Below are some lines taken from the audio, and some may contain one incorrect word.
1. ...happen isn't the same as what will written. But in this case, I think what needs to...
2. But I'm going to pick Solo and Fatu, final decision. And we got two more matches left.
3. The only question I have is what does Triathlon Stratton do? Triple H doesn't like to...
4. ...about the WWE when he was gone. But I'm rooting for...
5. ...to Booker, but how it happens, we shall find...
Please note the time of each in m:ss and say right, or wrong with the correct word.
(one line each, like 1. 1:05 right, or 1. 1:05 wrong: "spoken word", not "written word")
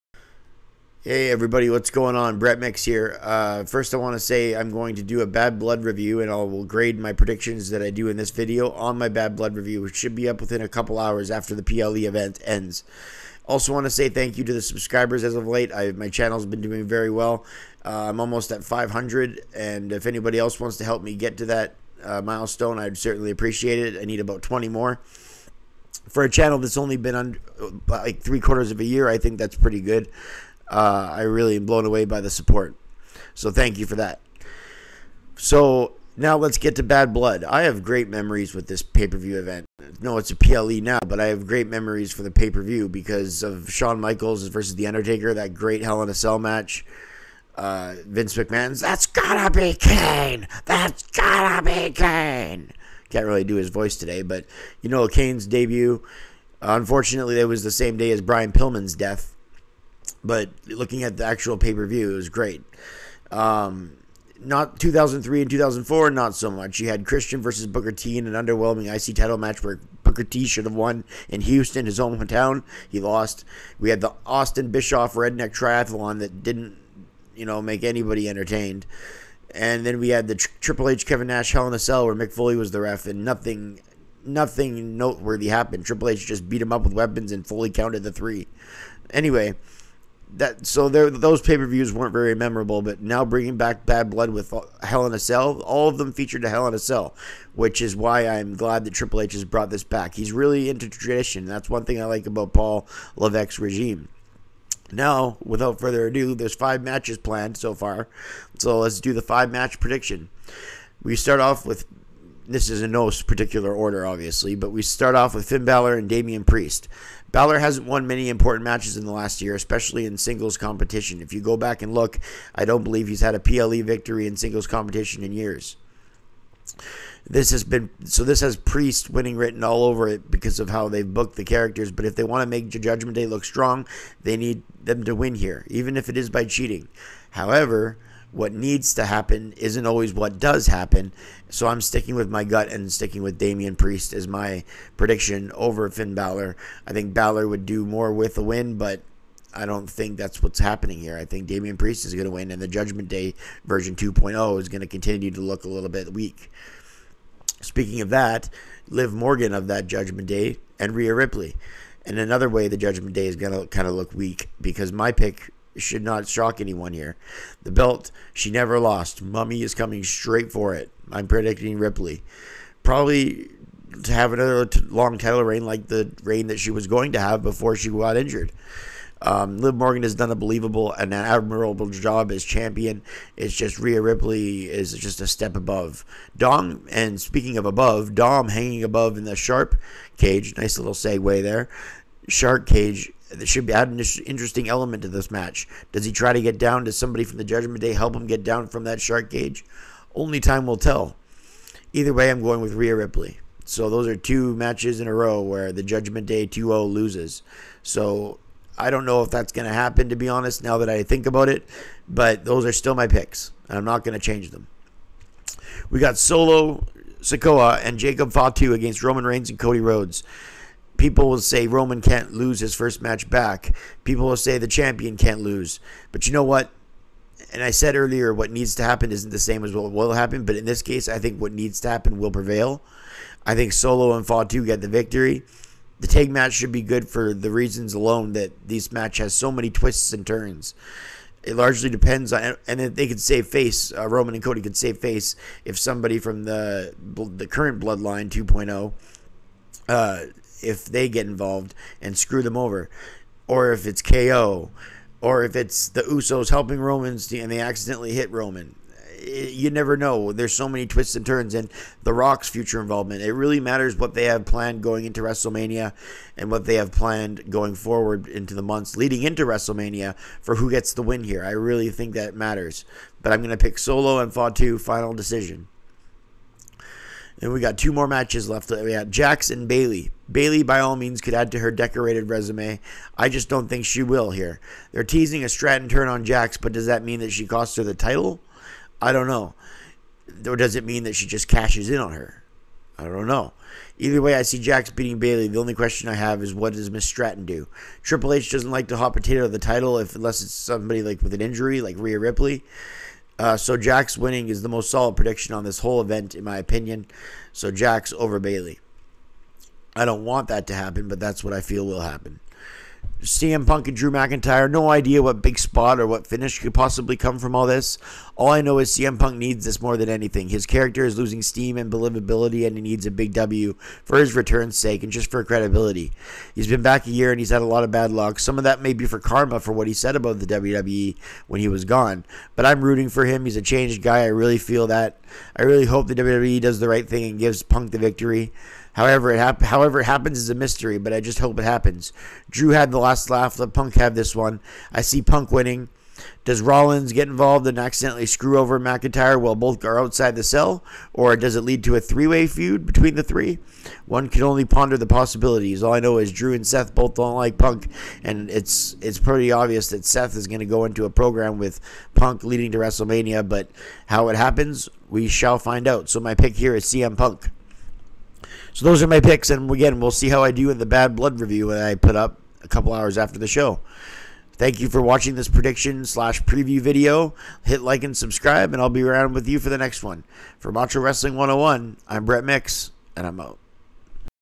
1. 3:48 wrong: "happen", not "written"
2. 4:33 right
3. 4:55 wrong: "Miss", not "Triathlon"
4. 5:30 right
5. 6:02 wrong: "WrestleMania", not "Booker".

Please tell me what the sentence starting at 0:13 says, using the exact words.
Also, want to say thank you to the subscribers as of late.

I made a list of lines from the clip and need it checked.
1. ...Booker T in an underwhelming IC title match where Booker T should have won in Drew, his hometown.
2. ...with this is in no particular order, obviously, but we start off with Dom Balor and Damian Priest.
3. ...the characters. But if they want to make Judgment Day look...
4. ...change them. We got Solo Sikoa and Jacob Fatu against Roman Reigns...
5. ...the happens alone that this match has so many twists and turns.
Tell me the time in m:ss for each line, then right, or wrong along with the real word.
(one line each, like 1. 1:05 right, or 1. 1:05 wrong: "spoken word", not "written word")
1. 1:07 wrong: "Houston", not "Drew"
2. 1:51 wrong: "Finn", not "Dom"
3. 2:11 right
4. 3:34 right
5. 3:57 wrong: "reasons", not "happens".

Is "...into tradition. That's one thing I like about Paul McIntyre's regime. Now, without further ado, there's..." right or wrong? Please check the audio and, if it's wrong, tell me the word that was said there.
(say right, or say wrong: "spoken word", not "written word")
wrong: "Levesque", not "McIntyre".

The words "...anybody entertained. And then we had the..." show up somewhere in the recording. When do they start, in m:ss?
1:17.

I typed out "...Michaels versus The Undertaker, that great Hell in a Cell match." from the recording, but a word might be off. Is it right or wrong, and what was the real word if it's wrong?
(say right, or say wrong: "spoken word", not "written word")
right.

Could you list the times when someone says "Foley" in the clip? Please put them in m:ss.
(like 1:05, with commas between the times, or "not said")
1:22, 1:27.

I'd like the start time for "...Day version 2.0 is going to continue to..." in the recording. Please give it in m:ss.
2:33.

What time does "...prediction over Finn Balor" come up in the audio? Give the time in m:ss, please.
2:24.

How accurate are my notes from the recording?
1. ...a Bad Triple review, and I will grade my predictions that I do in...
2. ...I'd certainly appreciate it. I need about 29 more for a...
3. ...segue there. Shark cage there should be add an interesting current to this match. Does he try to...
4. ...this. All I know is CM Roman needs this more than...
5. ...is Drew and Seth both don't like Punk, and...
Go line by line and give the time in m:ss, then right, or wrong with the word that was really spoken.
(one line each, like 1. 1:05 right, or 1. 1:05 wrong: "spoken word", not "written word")
1. 0:05 wrong: "Blood", not "Triple"
2. 0:22 wrong: "20", not "29"
3. 3:10 wrong: "element", not "current"
4. 5:17 wrong: "Punk", not "Roman"
5. 5:56 right.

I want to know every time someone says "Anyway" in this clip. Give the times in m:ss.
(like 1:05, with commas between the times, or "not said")
1:29.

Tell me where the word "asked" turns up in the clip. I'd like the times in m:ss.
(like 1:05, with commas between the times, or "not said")
not said.